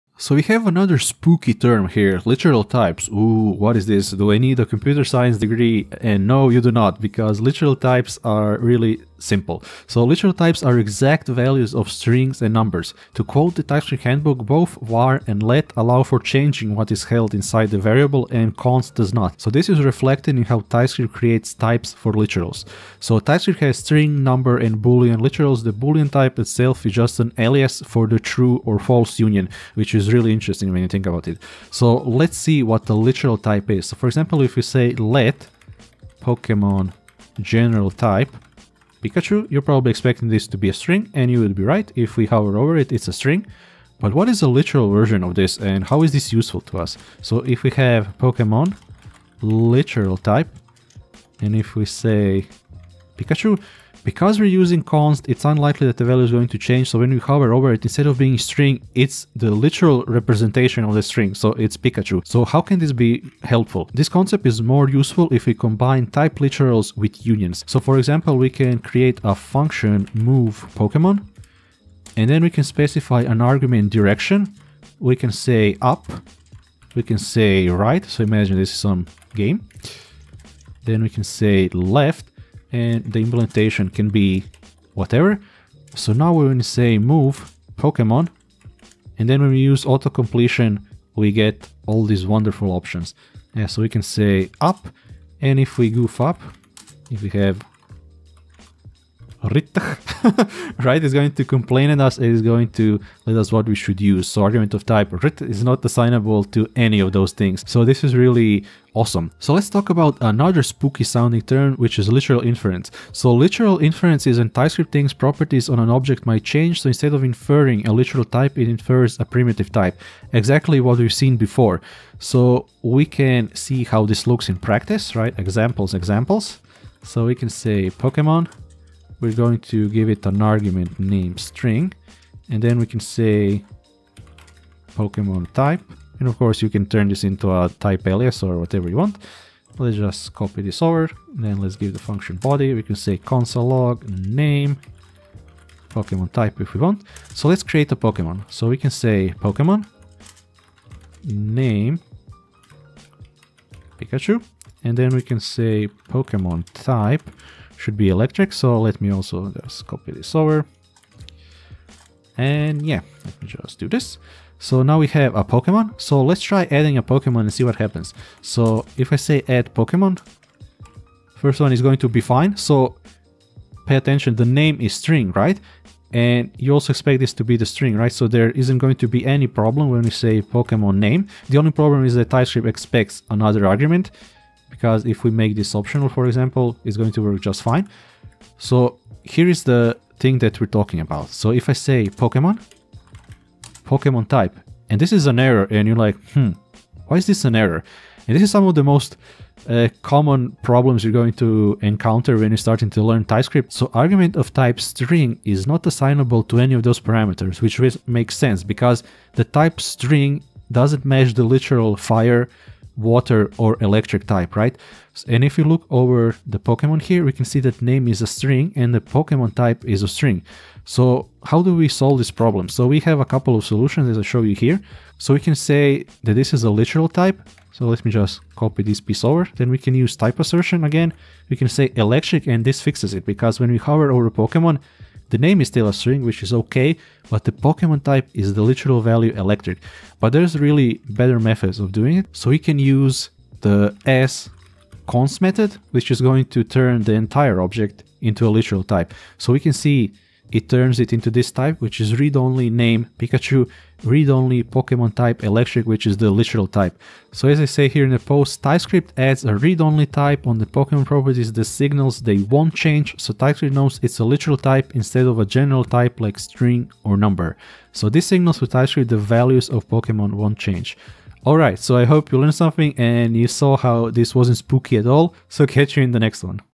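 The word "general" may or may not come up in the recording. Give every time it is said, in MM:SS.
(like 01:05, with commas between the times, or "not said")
00:37, 04:25.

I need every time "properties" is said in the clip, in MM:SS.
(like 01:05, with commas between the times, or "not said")
01:55, 04:21.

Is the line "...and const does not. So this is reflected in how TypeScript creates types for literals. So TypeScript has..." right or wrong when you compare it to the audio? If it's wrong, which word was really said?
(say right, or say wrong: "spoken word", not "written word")
right.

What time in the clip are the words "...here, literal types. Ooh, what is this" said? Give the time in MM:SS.
00:01.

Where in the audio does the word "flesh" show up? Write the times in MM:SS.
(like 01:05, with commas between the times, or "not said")
not said.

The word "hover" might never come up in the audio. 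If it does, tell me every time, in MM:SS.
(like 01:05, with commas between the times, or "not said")
00:42, 00:57, 03:53.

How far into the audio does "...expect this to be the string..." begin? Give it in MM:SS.
02:56.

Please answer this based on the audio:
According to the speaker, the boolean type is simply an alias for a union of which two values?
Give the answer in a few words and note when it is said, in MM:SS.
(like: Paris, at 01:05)
true or false, at 00:28.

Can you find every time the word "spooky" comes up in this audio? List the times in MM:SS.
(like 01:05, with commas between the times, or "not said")
00:00, 01:50, 04:34.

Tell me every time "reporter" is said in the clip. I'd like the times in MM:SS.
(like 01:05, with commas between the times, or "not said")
not said.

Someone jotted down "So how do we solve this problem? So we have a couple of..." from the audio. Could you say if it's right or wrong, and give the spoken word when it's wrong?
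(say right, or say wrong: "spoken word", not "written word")
right.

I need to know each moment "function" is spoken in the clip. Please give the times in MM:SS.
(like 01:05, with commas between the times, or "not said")
01:09, 02:22.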